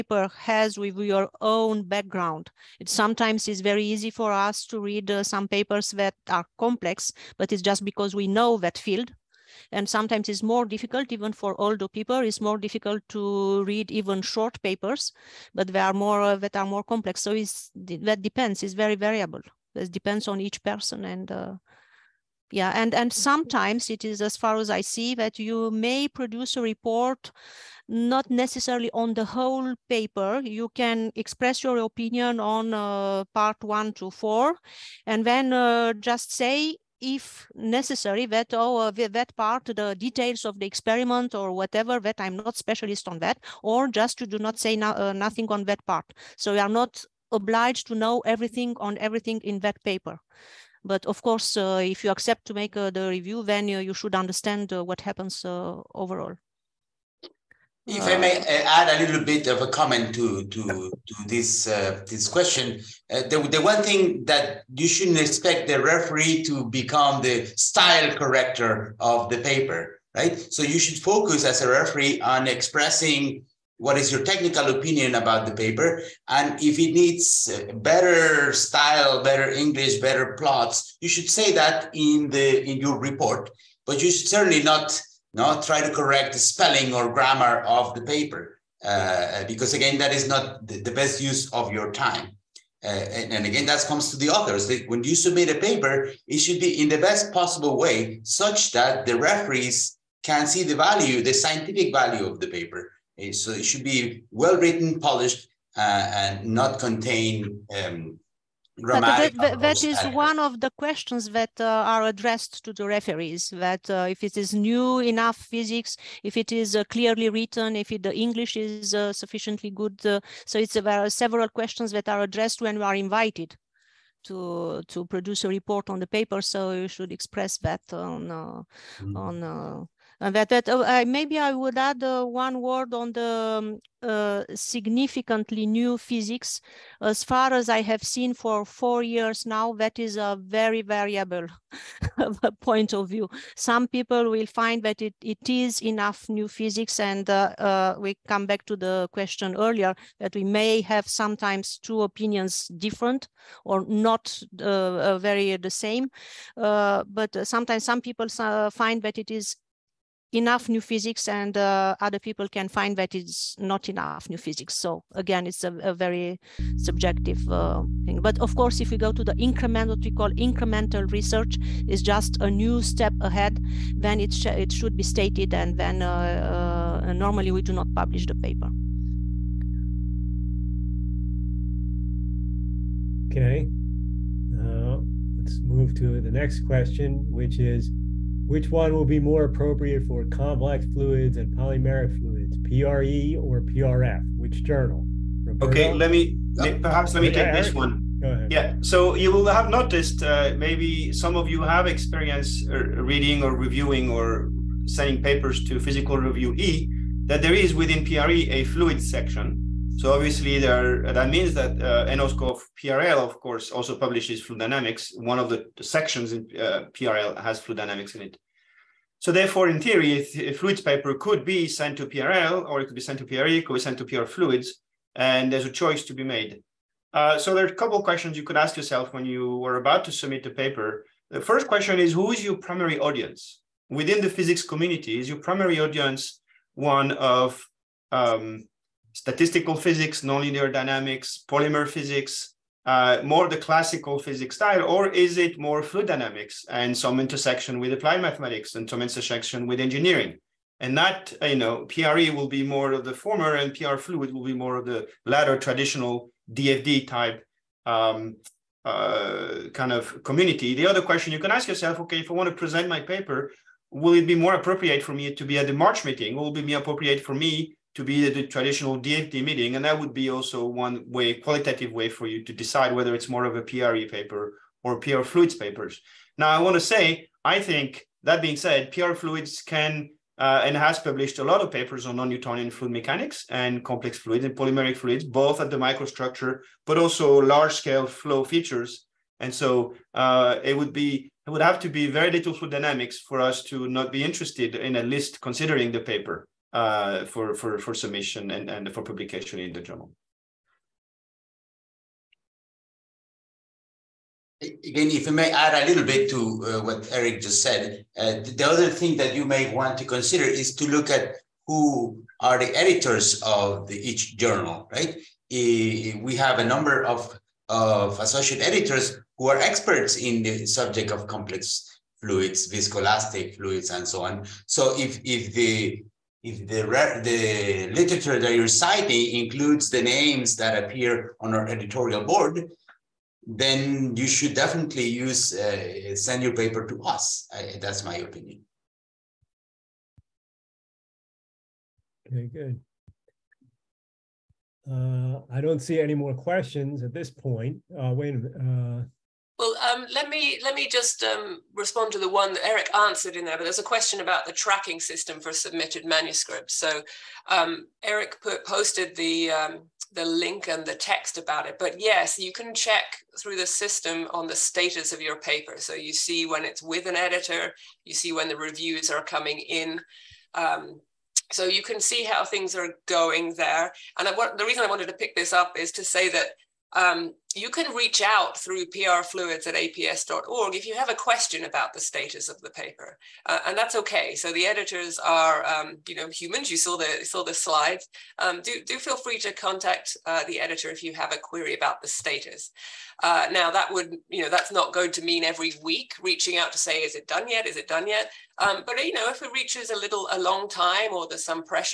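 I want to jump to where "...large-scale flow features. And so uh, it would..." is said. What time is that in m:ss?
4:47.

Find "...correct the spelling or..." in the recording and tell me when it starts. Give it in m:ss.
1:25.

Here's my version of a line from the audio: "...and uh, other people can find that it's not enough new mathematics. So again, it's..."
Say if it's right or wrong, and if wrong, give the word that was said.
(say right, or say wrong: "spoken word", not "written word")
wrong: "physics", not "mathematics".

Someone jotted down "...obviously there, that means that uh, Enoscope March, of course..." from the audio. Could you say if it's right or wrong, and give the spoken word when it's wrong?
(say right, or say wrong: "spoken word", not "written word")
wrong: "PRL", not "March".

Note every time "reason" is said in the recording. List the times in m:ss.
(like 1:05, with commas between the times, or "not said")
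6:14.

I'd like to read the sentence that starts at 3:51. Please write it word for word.
The first question is, who is your primary audience?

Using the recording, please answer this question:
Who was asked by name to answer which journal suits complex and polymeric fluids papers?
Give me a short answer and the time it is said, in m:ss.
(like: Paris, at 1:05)
Roberto, at 3:15.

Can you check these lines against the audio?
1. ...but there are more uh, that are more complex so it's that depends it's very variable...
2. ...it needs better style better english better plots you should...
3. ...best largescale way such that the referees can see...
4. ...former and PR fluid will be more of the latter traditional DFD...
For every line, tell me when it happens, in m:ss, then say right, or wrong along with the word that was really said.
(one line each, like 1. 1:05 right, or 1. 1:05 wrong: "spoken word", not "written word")
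1. 0:15 right
2. 1:16 right
3. 1:36 wrong: "possible", not "largescale"
4. 4:13 right.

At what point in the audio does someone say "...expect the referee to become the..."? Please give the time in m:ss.
1:05.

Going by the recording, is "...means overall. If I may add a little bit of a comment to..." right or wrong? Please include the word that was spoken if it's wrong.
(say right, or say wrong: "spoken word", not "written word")
wrong: "happens", not "means".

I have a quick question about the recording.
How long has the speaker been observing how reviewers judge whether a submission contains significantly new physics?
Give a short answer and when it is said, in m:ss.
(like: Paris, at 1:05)
4 years, at 2:18.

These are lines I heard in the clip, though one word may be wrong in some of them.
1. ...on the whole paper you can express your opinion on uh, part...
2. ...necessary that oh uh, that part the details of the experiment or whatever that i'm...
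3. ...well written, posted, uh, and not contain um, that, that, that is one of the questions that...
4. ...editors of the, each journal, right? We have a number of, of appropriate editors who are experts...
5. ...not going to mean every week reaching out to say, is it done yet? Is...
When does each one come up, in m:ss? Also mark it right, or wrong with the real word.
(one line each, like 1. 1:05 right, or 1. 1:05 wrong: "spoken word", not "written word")
1. 0:28 right
2. 0:37 right
3. 1:44 wrong: "polished", not "posted"
4. 5:12 wrong: "associate", not "appropriate"
5. 6:34 right.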